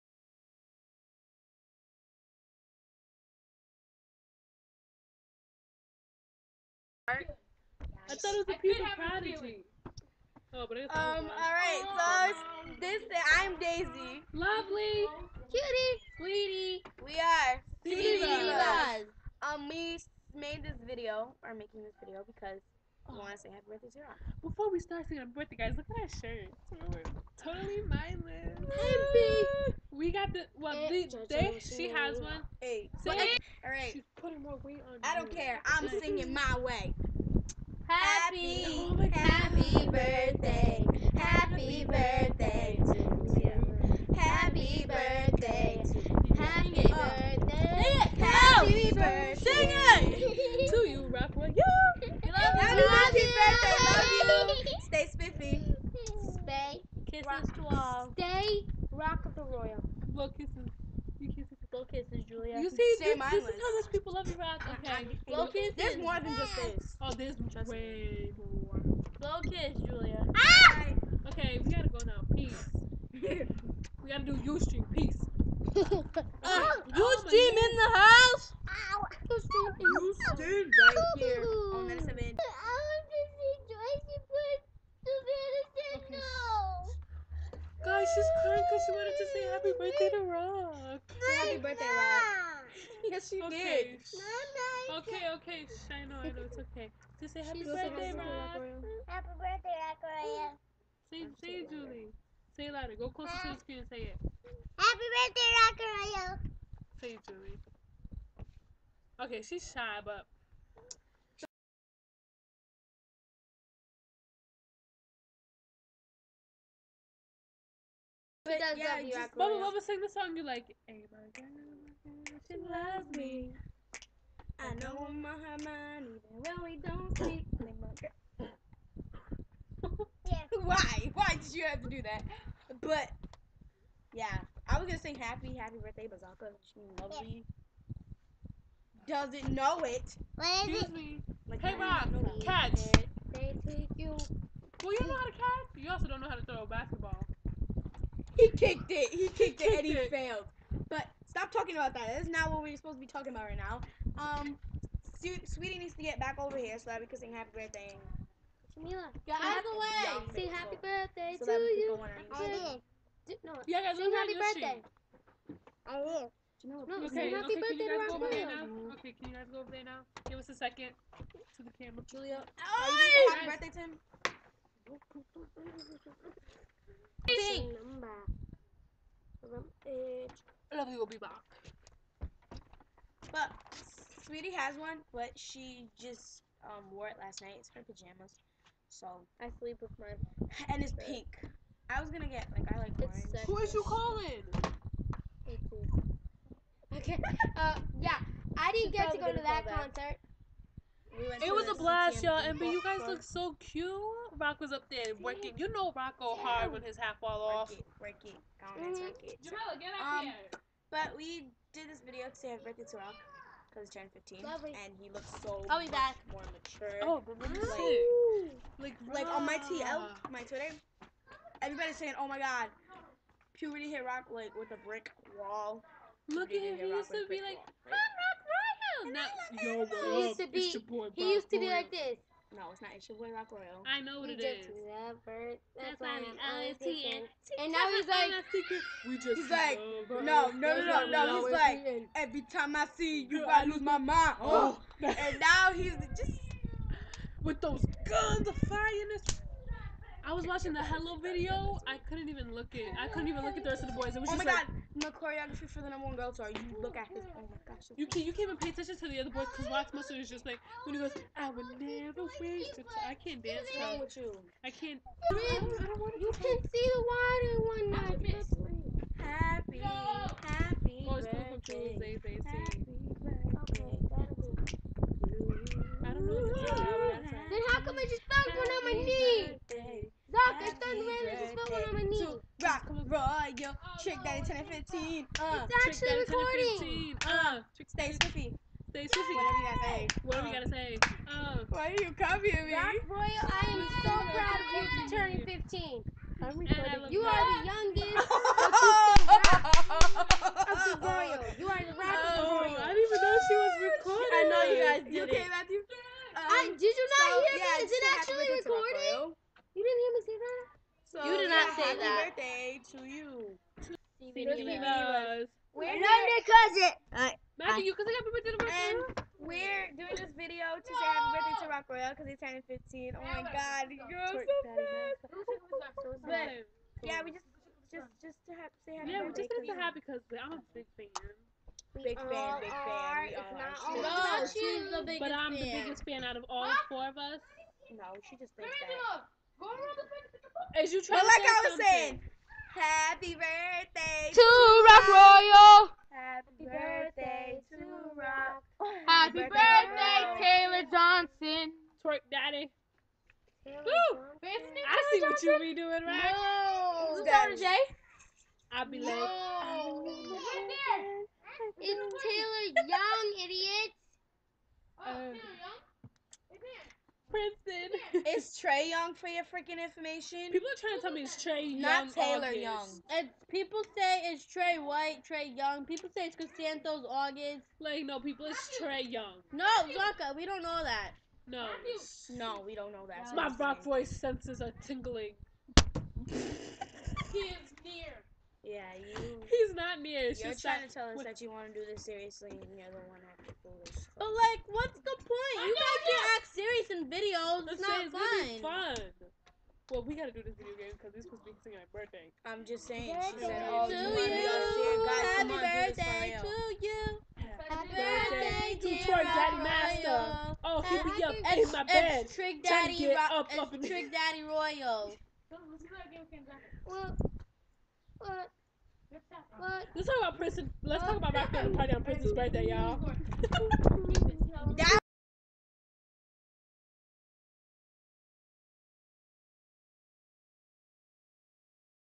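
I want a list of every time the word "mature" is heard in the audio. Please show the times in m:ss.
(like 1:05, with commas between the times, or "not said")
3:36.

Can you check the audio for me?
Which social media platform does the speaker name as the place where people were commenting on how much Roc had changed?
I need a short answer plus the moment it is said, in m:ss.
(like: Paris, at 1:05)
Twitter, at 3:40.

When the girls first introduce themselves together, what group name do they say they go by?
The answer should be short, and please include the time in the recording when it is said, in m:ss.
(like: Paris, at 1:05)
CV Divaz, at 0:17.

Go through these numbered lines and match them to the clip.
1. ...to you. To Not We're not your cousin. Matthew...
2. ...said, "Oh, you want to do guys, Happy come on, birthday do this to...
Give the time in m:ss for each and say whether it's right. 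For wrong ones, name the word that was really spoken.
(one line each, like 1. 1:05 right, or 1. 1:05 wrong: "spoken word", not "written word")
1. 5:12 wrong: "Steven", not "Not"
2. 6:43 right.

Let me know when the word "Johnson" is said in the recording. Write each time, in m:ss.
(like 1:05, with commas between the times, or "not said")
5:50, 5:55.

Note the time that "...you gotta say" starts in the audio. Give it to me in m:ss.
4:49.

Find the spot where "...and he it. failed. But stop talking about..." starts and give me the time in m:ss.
2:29.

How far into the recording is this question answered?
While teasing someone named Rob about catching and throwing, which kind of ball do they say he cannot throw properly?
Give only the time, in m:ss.
2:26.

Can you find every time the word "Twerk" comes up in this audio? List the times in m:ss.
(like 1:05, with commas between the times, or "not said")
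5:52, 6:49.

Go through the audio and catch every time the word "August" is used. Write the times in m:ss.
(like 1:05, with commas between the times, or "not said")
6:12, 6:17.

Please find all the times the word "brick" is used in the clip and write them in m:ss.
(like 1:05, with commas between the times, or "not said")
3:44.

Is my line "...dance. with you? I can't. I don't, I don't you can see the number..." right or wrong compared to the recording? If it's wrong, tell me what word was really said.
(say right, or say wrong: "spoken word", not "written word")
wrong: "water", not "number".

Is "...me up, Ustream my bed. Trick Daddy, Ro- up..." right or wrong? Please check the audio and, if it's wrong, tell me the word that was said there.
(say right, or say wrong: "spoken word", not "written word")
wrong: "Eddie", not "Ustream".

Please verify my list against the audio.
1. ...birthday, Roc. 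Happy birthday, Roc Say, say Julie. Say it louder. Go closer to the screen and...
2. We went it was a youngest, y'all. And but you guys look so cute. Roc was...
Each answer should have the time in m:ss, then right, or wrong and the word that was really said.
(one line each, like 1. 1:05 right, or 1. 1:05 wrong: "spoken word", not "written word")
1. 1:37 right
2. 3:21 wrong: "blast", not "youngest".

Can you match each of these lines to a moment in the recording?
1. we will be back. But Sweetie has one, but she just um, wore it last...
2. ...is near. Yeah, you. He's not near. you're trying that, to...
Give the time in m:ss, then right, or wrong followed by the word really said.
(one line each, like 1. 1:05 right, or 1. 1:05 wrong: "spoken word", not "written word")
1. 3:00 right
2. 6:27 right.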